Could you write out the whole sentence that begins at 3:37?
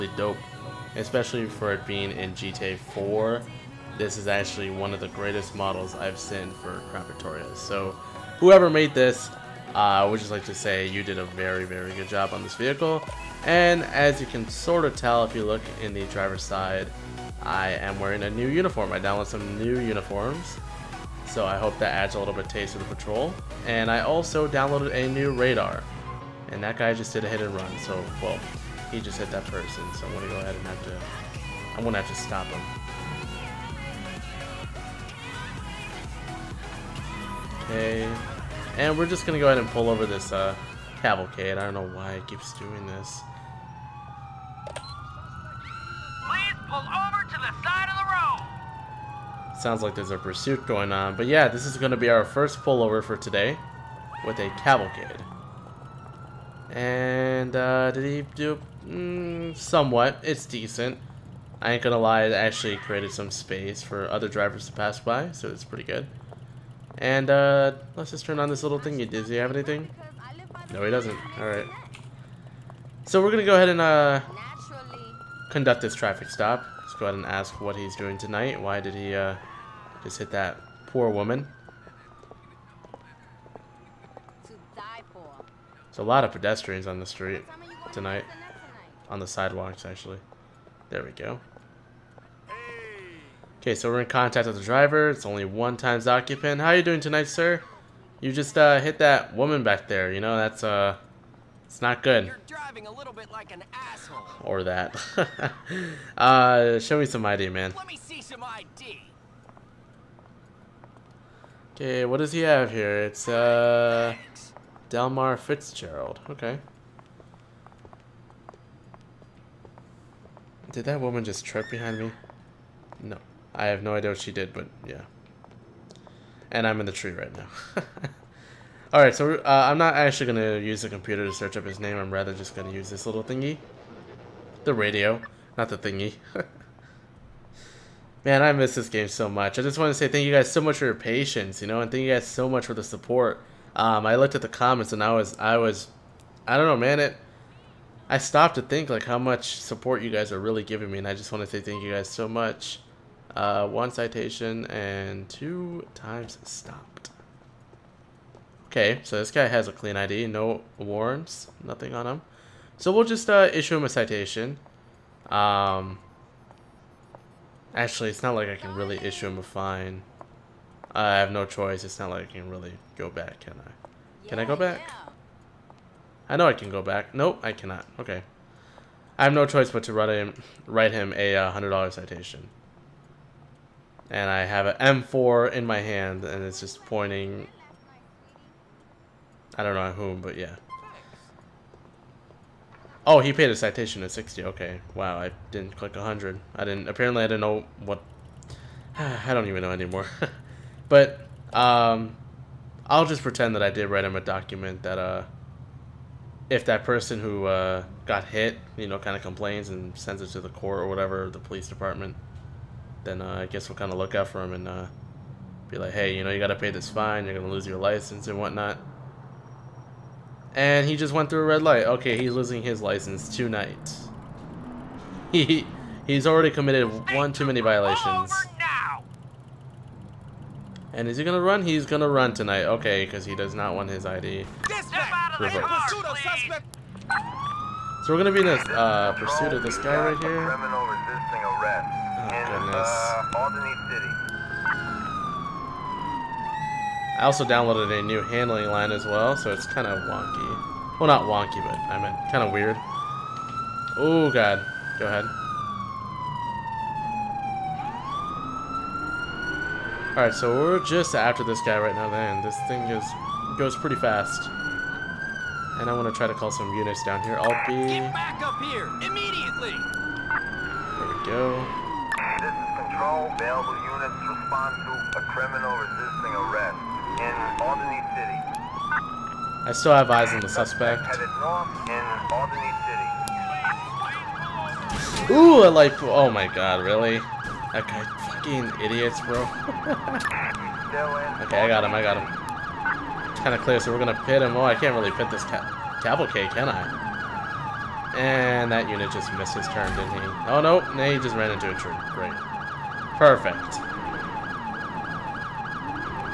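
You're going to lose your license and whatnot.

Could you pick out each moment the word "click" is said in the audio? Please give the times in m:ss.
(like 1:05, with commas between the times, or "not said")
3:15.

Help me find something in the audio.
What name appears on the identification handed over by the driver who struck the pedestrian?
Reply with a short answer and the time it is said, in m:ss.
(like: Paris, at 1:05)
Delmar Fitzgerald, at 1:54.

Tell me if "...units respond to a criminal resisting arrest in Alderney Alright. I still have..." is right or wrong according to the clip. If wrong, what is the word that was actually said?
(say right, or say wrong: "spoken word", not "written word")
wrong: "City", not "Alright".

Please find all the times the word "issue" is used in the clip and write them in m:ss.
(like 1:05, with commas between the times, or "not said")
2:43, 2:48.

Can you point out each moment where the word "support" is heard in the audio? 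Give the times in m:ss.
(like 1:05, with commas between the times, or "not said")
2:22, 2:29.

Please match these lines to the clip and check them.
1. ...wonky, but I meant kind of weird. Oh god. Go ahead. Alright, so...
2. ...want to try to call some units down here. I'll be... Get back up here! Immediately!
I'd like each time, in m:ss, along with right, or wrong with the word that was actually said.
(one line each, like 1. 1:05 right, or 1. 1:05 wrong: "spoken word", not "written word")
1. 4:11 right
2. 4:25 right.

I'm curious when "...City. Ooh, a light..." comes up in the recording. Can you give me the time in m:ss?
4:45.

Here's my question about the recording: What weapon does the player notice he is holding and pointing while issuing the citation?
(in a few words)
M4.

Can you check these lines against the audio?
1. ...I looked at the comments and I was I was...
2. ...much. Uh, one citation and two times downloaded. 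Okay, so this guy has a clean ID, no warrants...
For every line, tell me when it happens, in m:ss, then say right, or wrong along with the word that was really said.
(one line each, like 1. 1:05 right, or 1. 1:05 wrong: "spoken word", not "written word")
1. 2:24 right
2. 2:32 wrong: "stopped", not "downloaded".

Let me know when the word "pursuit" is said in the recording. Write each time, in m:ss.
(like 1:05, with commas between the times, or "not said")
0:50, 3:59.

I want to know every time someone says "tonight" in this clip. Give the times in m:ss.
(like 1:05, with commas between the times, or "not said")
1:18, 1:27, 1:37, 3:43, 3:52.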